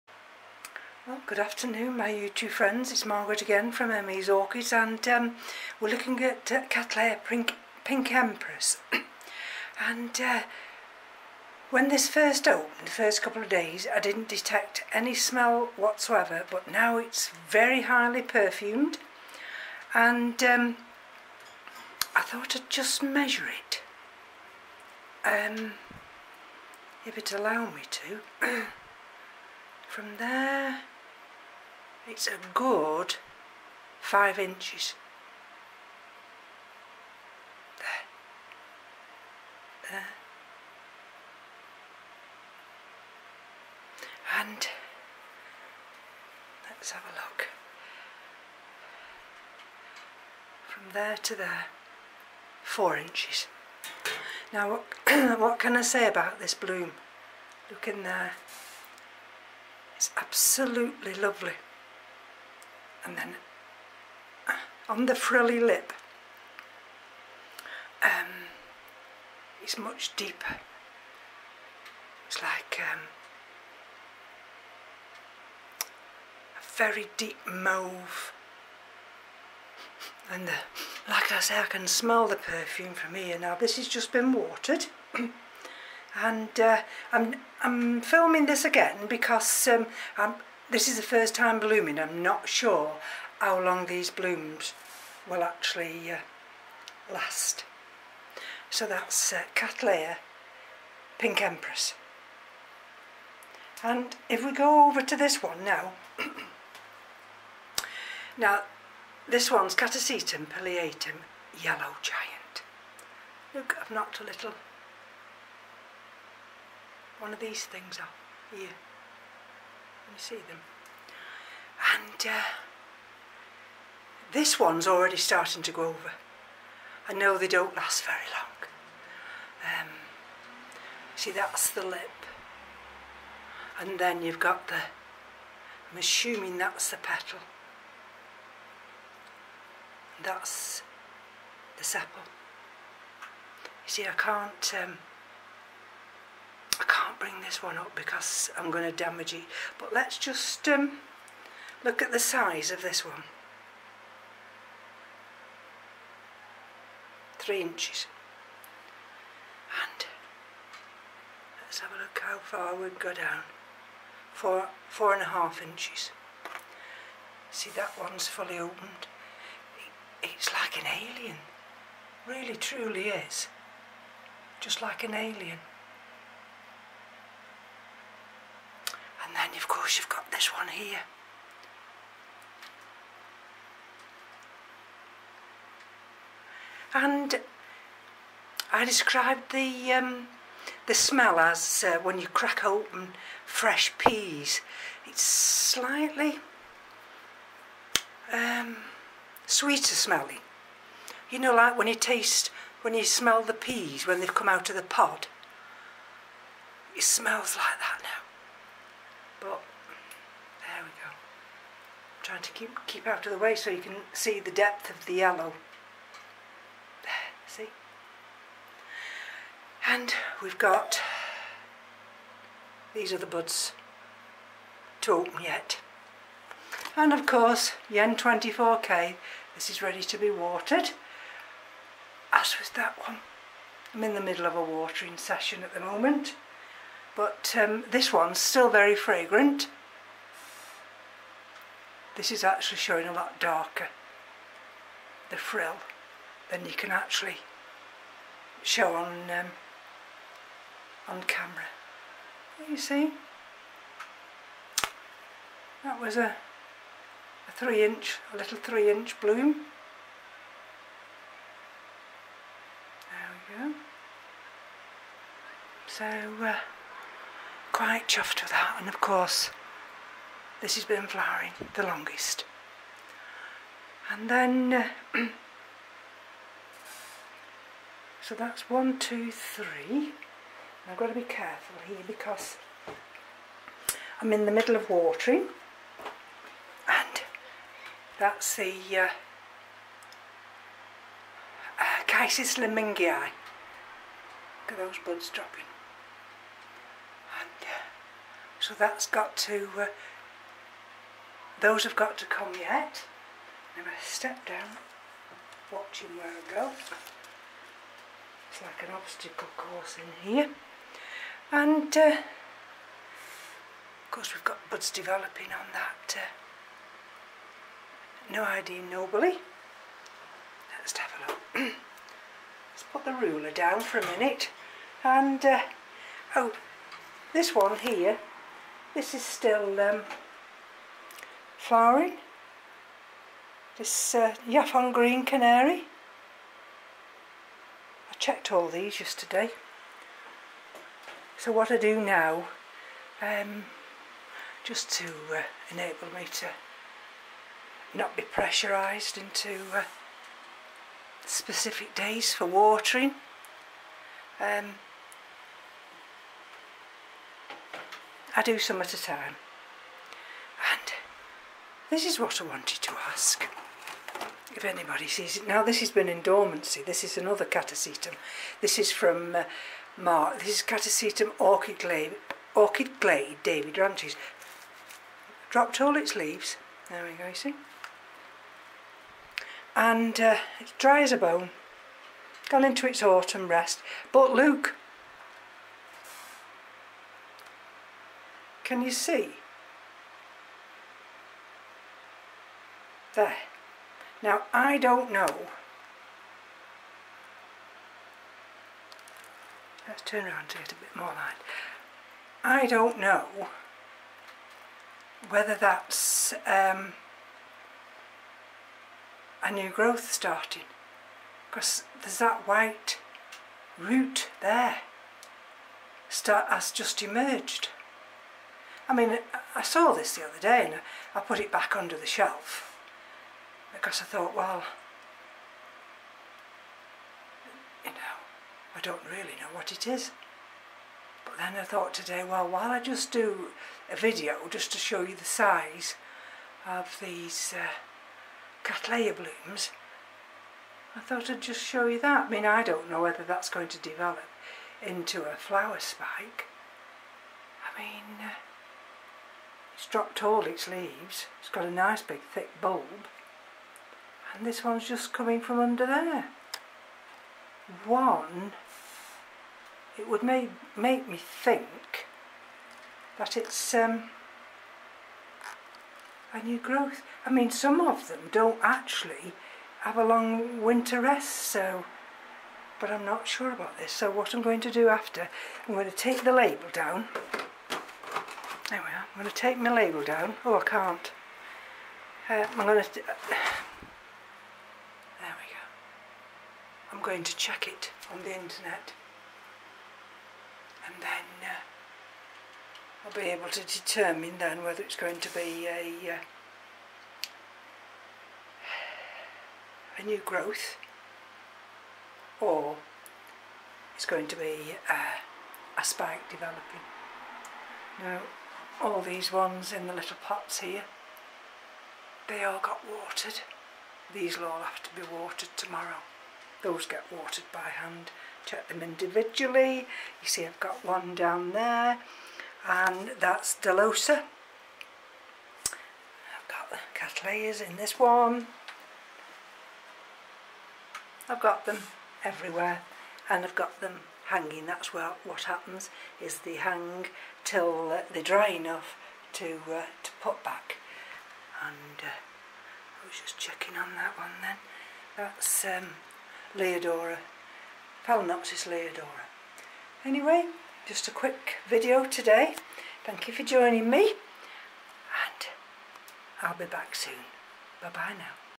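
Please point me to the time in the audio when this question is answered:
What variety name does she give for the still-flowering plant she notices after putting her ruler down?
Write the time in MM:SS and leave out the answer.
05:34.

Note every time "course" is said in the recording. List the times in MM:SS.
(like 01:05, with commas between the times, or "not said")
03:47, 04:28, 05:09, 05:14.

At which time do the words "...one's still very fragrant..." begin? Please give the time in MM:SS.
03:58.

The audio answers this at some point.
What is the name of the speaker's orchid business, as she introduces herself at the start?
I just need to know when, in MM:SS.
00:03.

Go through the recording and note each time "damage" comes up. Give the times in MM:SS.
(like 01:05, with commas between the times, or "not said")
02:28.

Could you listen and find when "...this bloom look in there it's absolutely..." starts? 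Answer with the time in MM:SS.
00:56.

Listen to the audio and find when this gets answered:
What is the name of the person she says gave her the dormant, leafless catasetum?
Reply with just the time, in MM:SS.
06:09.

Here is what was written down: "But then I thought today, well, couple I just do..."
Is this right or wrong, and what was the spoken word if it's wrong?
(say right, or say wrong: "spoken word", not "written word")
wrong: "while", not "couple".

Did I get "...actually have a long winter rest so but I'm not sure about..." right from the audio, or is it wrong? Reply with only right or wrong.
right.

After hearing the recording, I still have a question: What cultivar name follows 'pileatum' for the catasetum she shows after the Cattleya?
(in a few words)
Yellow Giant.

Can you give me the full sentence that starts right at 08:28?
Now all these ones in the little pots here they all got watered.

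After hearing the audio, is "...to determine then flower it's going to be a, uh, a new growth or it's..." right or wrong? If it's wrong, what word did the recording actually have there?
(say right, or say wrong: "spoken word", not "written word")
wrong: "whether", not "flower".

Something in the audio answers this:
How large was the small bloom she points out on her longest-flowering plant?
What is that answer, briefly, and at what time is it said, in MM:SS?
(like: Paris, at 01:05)
3 inches, at 04:18.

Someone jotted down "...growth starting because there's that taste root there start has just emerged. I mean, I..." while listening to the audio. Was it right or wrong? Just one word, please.
wrong.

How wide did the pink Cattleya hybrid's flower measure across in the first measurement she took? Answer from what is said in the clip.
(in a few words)
5 inches.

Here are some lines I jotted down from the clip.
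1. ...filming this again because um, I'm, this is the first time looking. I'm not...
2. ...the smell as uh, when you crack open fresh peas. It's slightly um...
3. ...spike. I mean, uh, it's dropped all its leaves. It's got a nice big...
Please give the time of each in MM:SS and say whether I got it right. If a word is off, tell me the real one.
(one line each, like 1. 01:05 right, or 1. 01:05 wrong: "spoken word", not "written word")
1. 01:28 wrong: "blooming", not "looking"
2. 03:10 right
3. 07:25 right.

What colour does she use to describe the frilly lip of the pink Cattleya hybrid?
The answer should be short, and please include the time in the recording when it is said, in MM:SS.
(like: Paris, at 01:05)
Deep mauve, at 01:16.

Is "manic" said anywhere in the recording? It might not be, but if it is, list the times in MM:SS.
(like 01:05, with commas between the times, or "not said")
not said.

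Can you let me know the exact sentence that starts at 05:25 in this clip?
And uh, oh, this one here, this is still um, flowering.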